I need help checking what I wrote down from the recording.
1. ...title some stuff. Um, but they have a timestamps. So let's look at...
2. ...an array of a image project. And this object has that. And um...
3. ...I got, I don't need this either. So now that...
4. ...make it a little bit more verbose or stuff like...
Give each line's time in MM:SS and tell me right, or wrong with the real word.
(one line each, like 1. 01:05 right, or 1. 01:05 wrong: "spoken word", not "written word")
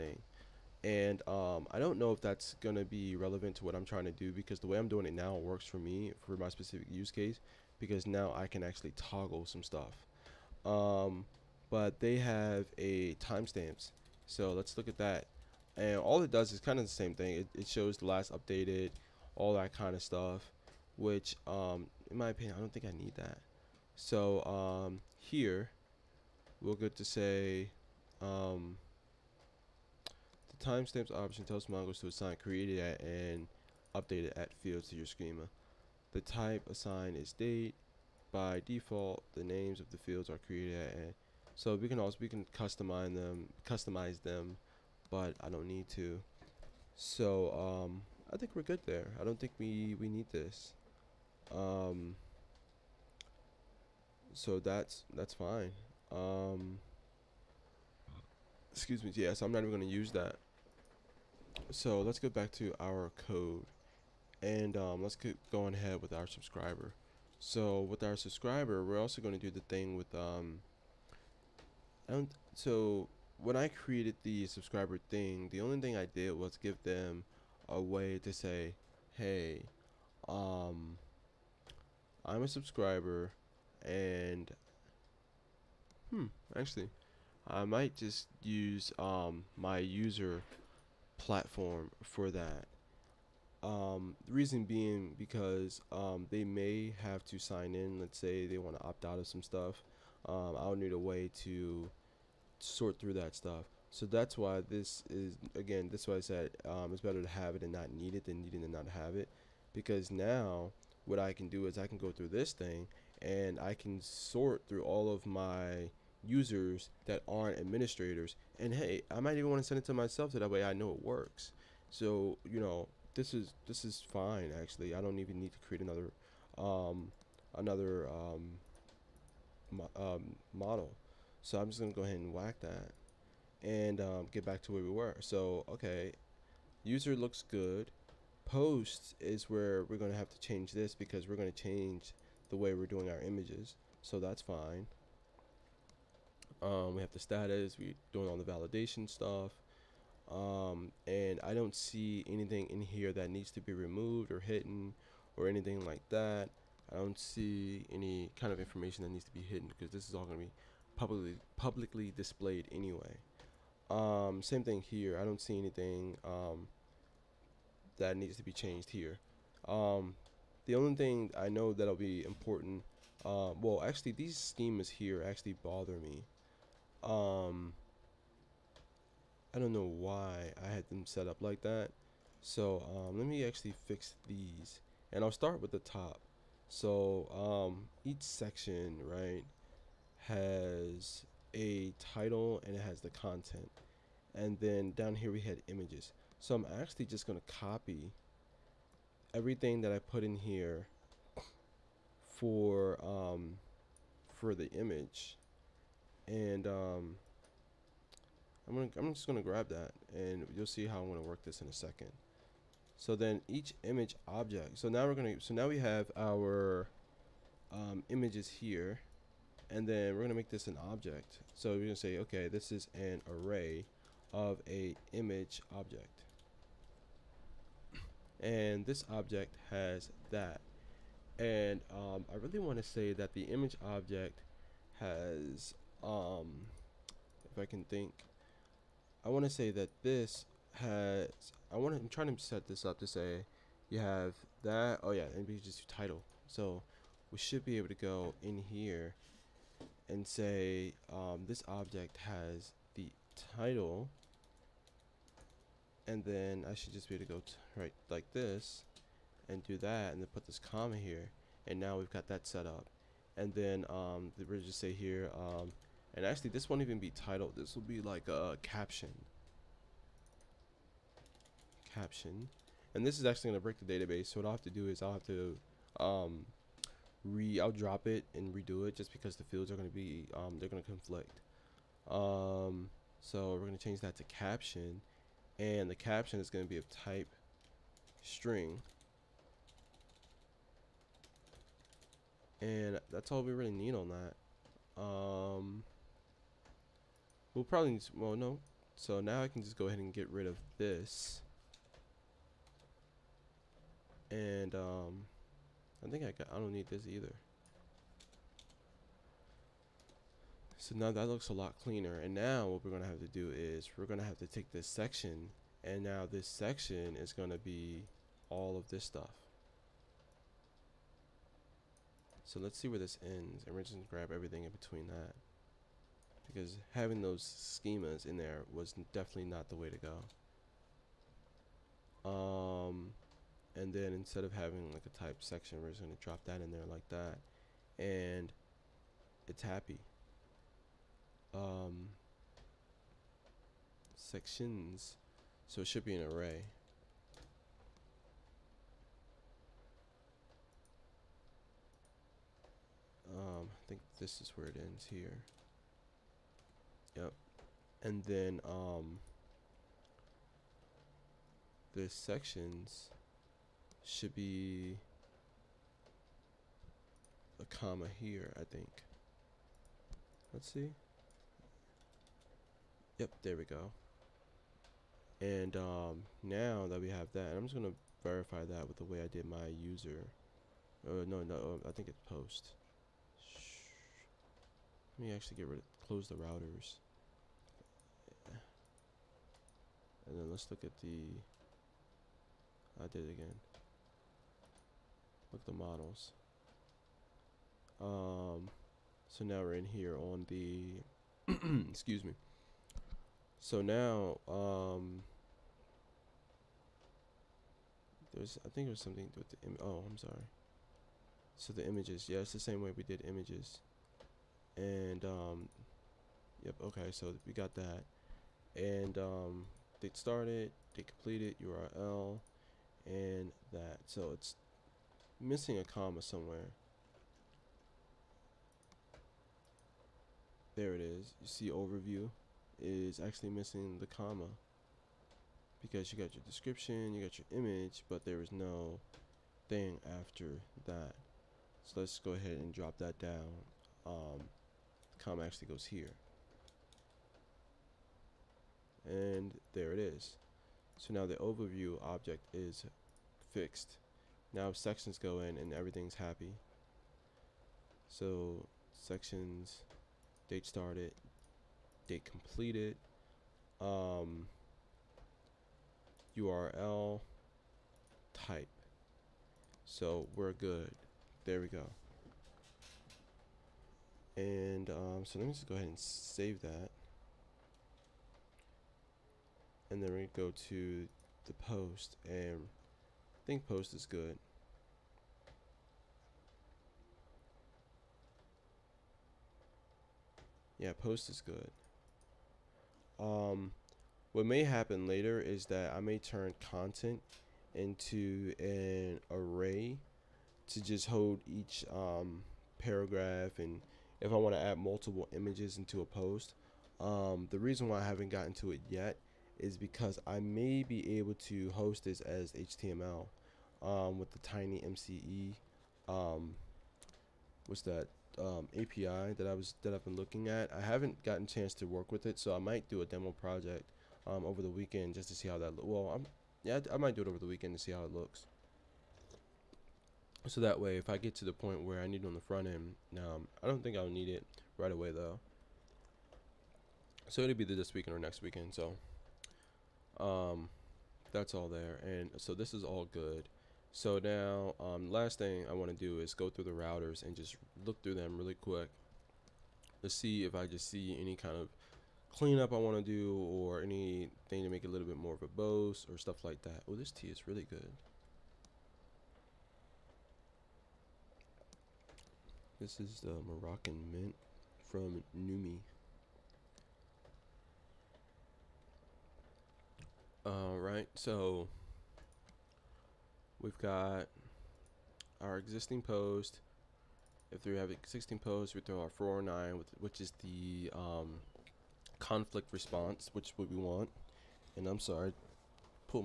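1. 00:08 wrong: "toggle", not "title"
2. 03:42 wrong: "object", not "project"
3. 05:06 right
4. 09:14 right.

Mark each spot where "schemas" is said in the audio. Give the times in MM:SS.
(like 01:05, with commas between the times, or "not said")
00:35, 02:54, 05:27.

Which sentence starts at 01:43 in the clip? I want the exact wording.
So that's why this is again.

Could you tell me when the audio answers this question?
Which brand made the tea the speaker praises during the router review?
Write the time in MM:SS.
09:25.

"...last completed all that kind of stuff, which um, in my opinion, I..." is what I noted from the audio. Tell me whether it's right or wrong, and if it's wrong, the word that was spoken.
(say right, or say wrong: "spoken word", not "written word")
wrong: "updated", not "completed".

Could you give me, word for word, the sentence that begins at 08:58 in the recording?
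So um, that's all there, and so this is all good.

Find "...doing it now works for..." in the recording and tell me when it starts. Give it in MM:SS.
00:04.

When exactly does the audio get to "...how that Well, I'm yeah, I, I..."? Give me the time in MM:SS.
08:45.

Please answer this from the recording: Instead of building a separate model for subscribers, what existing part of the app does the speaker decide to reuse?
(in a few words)
user platform.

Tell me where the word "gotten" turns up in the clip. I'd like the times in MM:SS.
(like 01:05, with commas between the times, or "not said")
08:28, 08:41.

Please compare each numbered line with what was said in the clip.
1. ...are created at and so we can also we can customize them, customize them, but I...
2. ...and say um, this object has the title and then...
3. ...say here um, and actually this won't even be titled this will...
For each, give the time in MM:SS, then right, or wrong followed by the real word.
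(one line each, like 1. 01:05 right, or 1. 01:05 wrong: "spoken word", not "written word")
1. 00:40 right
2. 04:10 right
3. 04:24 right.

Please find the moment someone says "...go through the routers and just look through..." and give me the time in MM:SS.
09:06.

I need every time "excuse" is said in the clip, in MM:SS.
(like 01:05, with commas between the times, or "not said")
00:58, 06:41.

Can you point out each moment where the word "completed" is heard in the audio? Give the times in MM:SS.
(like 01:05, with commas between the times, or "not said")
07:01, 07:42.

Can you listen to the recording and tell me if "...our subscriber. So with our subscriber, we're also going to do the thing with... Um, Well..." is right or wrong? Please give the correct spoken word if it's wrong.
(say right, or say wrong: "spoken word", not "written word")
wrong: "And", not "Well".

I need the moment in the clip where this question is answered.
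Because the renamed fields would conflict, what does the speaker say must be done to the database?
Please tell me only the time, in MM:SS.
04:37.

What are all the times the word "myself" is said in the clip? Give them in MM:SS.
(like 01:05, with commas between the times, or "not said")
01:59.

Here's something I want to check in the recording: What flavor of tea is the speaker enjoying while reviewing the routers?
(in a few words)
Moroccan mint.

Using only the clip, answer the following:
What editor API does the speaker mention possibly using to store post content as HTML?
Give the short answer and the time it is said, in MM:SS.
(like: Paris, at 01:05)
TinyMCE, at 08:34.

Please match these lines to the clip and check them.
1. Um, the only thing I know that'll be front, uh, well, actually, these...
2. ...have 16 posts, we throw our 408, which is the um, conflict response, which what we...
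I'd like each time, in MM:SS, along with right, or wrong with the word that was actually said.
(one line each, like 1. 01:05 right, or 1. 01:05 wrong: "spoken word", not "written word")
1. 02:49 wrong: "important", not "front"
2. 09:37 wrong: "409", not "408".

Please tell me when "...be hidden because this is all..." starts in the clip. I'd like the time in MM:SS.
02:39.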